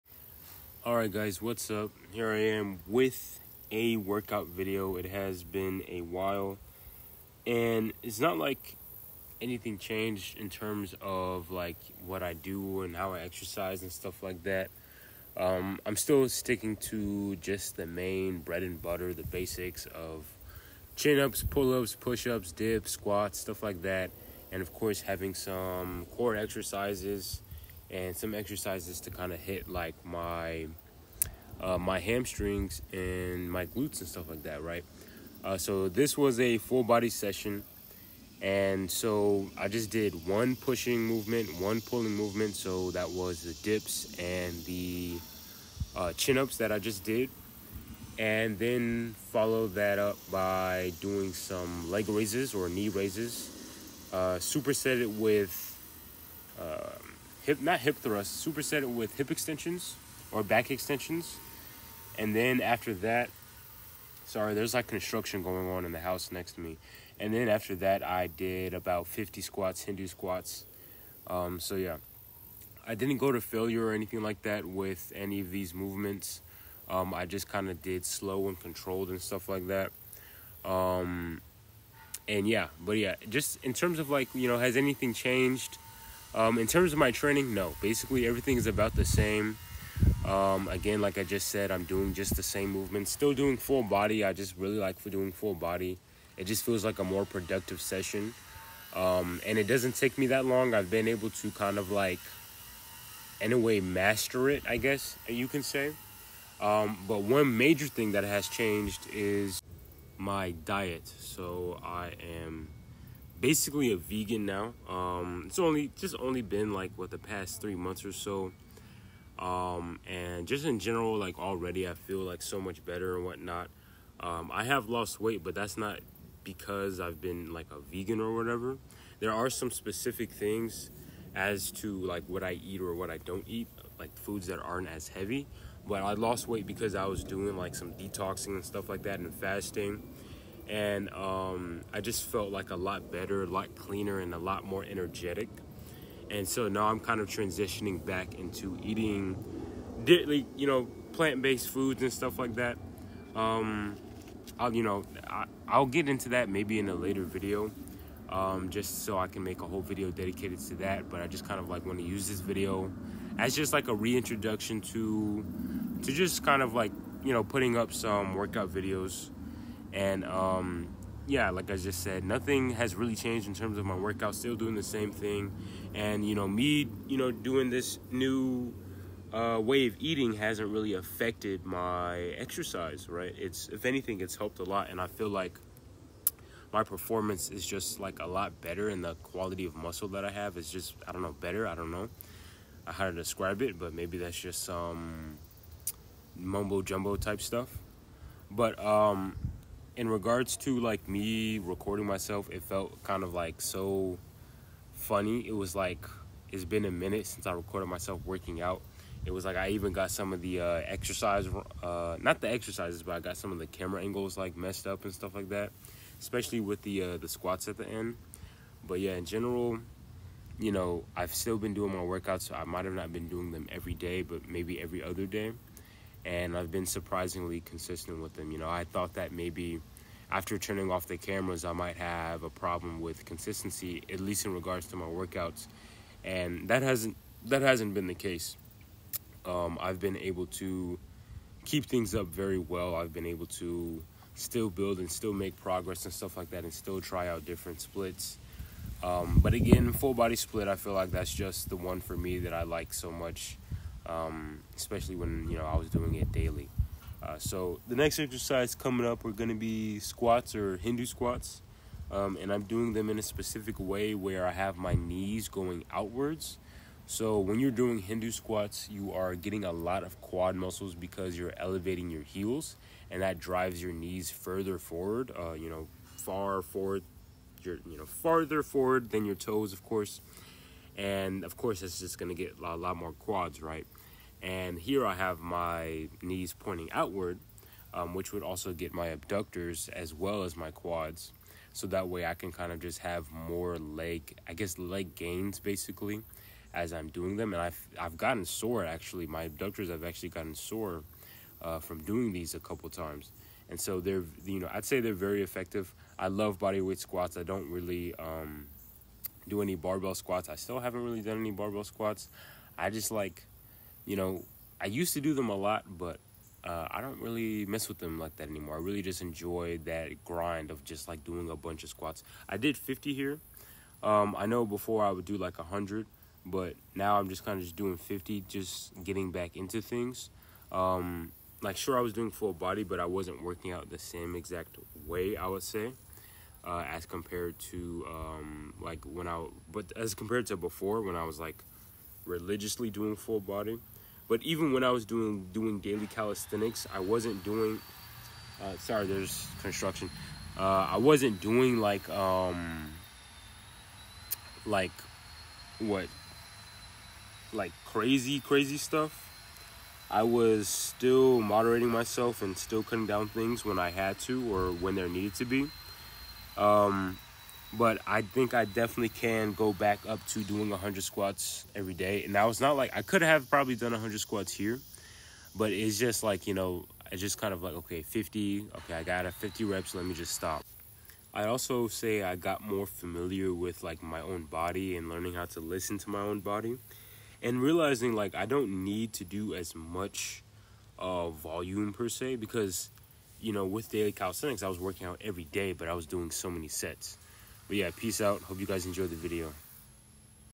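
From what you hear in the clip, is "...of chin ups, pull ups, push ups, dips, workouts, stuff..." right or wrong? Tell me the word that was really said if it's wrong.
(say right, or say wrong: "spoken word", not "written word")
wrong: "squats", not "workouts".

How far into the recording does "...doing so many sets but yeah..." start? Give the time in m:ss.
6:36.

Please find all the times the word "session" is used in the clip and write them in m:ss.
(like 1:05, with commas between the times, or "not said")
0:37, 1:37.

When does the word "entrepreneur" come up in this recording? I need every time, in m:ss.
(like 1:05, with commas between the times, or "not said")
not said.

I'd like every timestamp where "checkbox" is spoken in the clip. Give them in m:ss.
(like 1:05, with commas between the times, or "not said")
not said.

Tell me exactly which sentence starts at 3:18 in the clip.
But um, in regards to like me recording myself, it felt kind of like so funny.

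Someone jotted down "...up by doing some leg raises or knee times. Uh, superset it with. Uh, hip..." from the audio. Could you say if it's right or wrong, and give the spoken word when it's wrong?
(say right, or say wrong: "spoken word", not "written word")
wrong: "raises", not "times".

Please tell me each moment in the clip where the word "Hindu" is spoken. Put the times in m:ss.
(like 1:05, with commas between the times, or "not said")
1:09, 4:20, 4:27.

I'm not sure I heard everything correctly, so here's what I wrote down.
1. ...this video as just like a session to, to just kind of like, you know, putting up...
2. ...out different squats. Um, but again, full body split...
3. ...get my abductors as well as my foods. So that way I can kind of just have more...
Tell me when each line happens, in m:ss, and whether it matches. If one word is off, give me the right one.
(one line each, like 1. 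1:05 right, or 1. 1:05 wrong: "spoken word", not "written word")
1. 2:42 wrong: "reintroduction", not "session"
2. 4:07 wrong: "splits", not "squats"
3. 4:48 wrong: "quads", not "foods".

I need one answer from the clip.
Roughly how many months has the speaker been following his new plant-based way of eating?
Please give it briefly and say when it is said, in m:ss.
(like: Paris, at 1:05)
3, at 1:57.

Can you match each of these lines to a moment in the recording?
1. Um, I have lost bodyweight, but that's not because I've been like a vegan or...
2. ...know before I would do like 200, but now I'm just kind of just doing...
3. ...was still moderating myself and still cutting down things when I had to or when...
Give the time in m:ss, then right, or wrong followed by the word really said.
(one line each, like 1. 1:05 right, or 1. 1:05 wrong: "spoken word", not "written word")
1. 2:04 wrong: "weight", not "bodyweight"
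2. 5:24 wrong: "100", not "200"
3. 6:00 right.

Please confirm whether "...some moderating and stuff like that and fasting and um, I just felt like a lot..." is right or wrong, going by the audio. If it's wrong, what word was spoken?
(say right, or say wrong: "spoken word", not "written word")
wrong: "detoxing", not "moderating".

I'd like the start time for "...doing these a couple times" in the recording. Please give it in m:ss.
5:02.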